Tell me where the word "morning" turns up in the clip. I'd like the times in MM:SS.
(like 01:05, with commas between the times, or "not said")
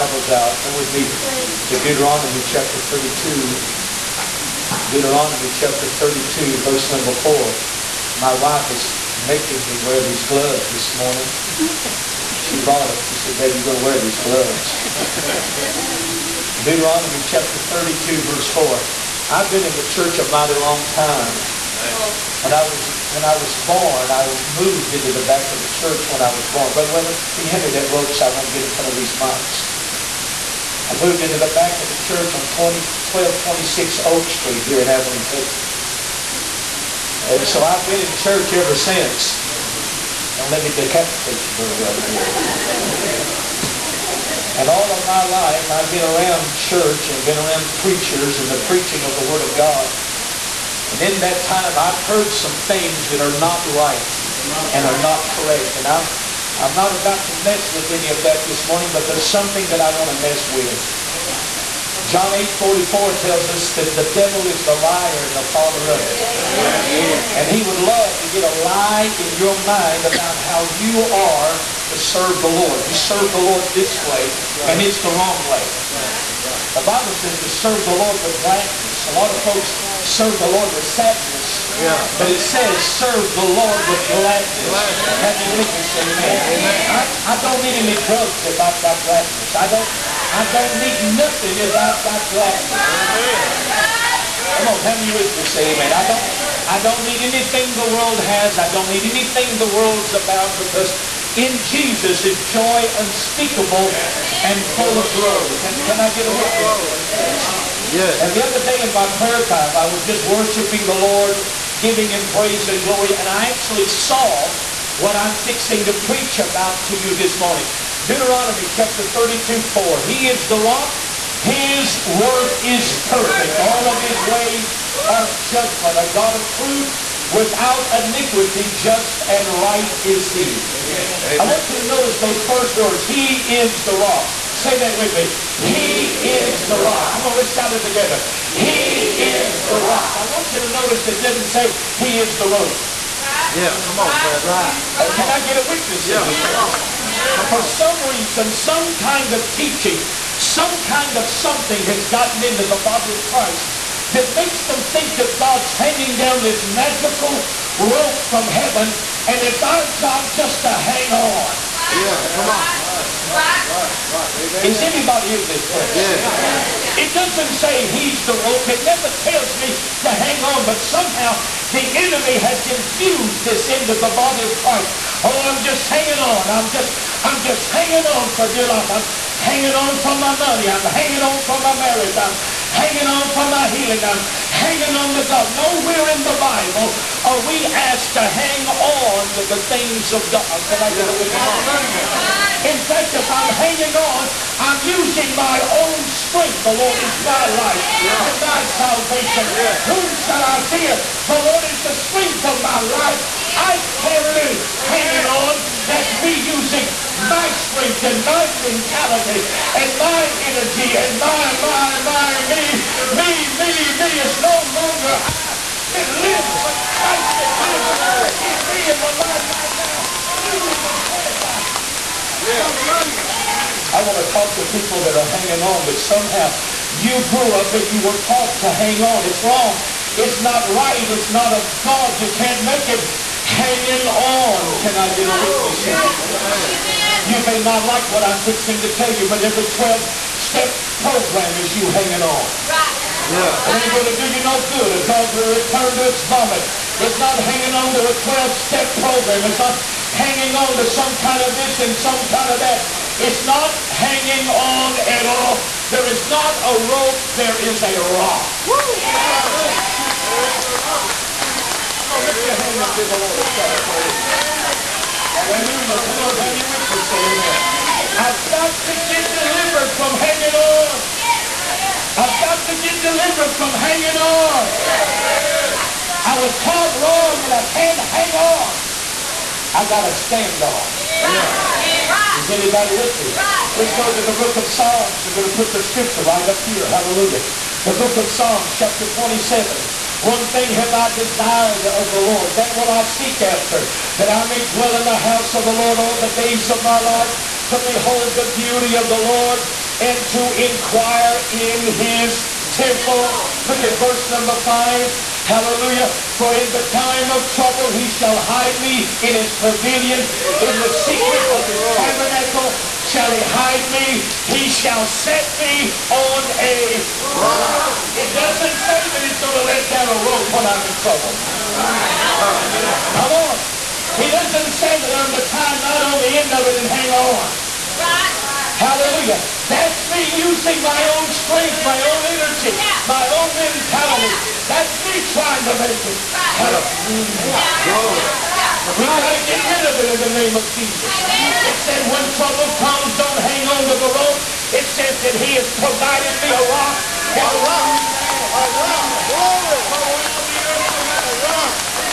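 00:10, 00:58, 01:57.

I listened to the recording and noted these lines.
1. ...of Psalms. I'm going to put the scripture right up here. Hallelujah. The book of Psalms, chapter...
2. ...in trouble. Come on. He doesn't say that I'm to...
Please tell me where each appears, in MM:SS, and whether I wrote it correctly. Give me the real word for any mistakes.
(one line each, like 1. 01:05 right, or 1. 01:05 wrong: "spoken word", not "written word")
1. 04:44 right
2. 05:20 right.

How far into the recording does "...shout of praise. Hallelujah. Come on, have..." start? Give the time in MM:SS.
04:23.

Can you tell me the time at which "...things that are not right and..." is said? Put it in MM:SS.
00:52.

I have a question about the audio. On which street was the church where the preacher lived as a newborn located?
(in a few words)
Oak Street.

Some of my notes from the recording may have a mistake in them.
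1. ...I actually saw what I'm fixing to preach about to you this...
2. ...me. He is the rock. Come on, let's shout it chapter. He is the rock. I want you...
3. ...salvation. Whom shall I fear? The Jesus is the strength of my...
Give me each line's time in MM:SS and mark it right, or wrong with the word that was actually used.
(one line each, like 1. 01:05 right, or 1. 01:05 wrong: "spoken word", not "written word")
1. 01:53 right
2. 02:15 wrong: "together", not "chapter"
3. 03:18 wrong: "Lord", not "Jesus".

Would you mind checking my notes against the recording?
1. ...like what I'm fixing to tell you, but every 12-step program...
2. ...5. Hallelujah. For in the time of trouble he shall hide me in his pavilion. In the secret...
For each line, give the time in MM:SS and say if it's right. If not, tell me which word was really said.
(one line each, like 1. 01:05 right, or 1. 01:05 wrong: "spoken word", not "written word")
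1. 03:57 right
2. 05:04 right.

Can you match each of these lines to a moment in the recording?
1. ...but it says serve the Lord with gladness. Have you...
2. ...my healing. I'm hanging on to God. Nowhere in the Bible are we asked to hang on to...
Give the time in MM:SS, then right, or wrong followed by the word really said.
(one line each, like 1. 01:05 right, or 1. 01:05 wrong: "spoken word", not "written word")
1. 01:22 right
2. 03:03 right.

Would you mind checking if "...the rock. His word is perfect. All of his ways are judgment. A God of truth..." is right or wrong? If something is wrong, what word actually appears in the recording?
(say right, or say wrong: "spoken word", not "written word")
right.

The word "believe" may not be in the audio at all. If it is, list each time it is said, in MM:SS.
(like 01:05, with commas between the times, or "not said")
01:25.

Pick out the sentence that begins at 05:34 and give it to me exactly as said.
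That's me trying to make it.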